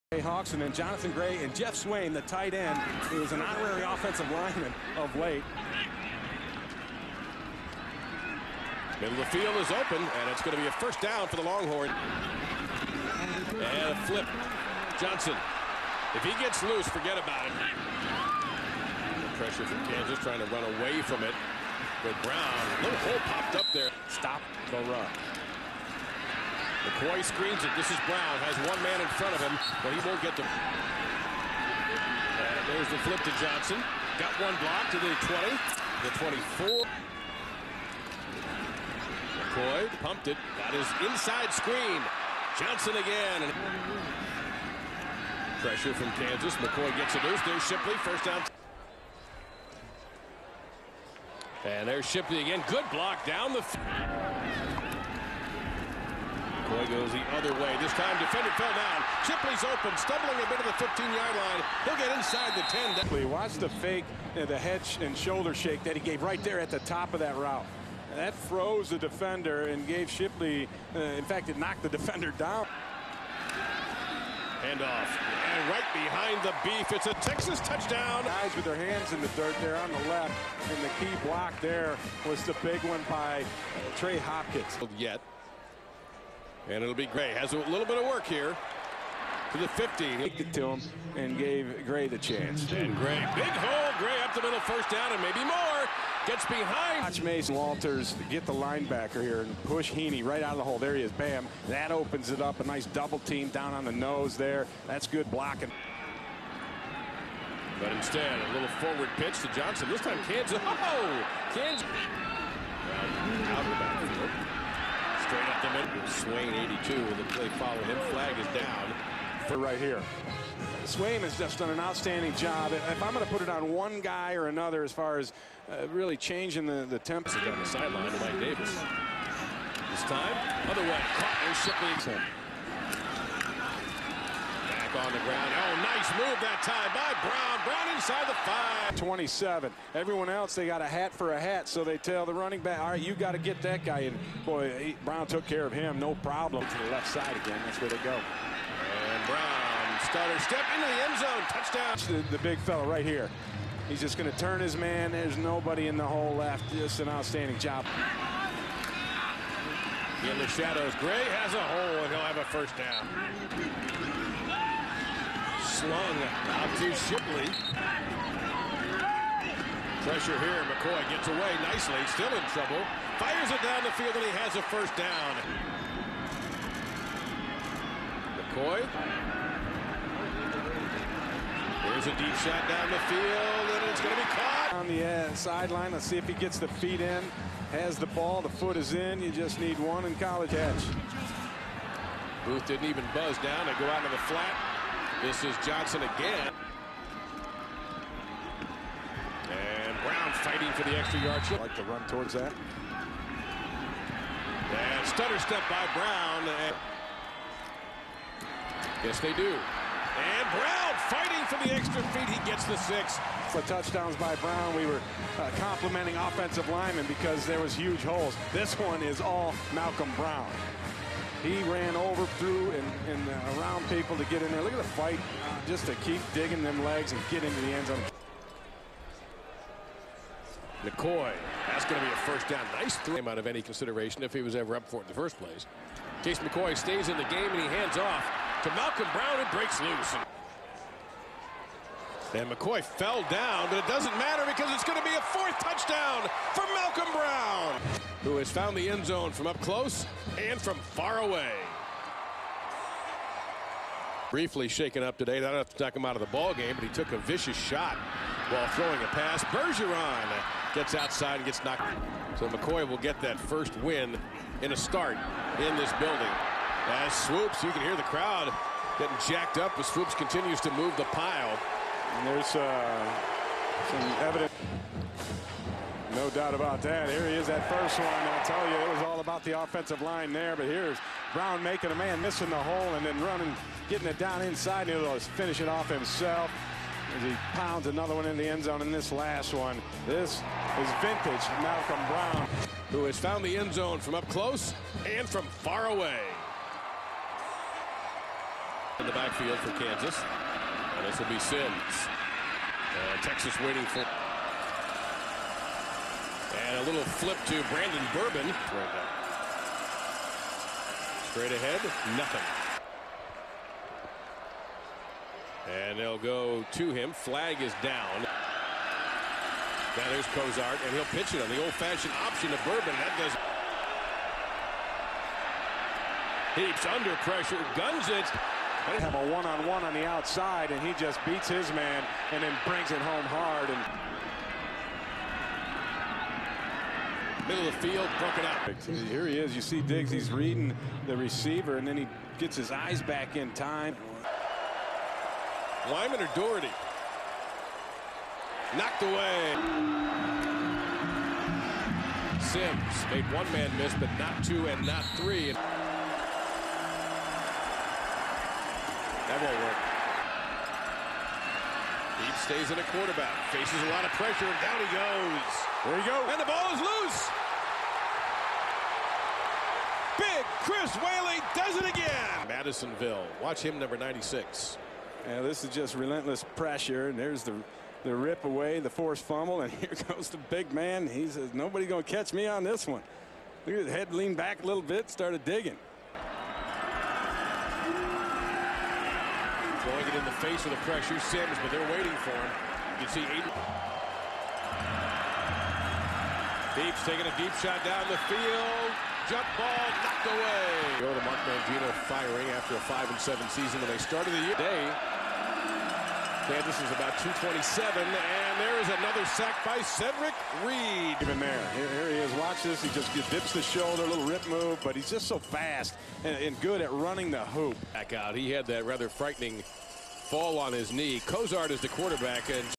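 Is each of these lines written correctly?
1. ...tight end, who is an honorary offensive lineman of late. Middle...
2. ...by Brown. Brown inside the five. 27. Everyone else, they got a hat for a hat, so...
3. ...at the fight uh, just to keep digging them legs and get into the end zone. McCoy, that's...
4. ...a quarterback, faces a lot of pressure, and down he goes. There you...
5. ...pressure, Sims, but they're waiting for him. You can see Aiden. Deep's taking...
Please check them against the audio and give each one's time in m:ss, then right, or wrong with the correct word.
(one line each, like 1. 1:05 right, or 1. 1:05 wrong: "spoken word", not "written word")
1. 0:02 right
2. 2:16 right
3. 3:44 right
4. 6:02 right
5. 6:30 right.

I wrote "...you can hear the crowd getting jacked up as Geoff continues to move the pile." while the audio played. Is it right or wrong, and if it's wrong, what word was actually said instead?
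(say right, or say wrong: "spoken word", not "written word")
wrong: "Swoopes", not "Geoff".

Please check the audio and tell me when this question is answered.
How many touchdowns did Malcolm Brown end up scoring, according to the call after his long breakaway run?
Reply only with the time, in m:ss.
4:05.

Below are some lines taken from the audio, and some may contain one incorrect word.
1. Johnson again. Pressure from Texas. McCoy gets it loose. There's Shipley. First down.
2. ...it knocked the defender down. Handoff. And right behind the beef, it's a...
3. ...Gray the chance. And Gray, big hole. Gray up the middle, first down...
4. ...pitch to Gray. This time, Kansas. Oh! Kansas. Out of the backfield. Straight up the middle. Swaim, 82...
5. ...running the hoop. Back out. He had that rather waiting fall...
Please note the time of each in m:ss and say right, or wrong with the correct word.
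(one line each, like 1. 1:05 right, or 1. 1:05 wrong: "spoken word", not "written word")
1. 0:42 wrong: "Kansas", not "Texas"
2. 1:11 right
3. 1:31 right
4. 1:49 wrong: "Johnson", not "Gray"
5. 6:56 wrong: "frightening", not "waiting".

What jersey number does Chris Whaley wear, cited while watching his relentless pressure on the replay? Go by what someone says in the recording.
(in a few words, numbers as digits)
96.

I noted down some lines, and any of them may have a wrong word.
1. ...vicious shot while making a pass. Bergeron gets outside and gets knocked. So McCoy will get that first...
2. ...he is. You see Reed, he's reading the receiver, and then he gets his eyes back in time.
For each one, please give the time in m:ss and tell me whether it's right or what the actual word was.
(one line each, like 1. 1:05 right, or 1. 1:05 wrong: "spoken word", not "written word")
1. 4:17 wrong: "throwing", not "making"
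2. 5:39 wrong: "Diggs", not "Reed".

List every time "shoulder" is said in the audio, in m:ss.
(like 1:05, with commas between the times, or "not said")
1:05, 6:53.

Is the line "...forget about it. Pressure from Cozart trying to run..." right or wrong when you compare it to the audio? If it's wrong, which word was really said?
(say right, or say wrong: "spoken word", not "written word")
wrong: "Kansas", not "Cozart".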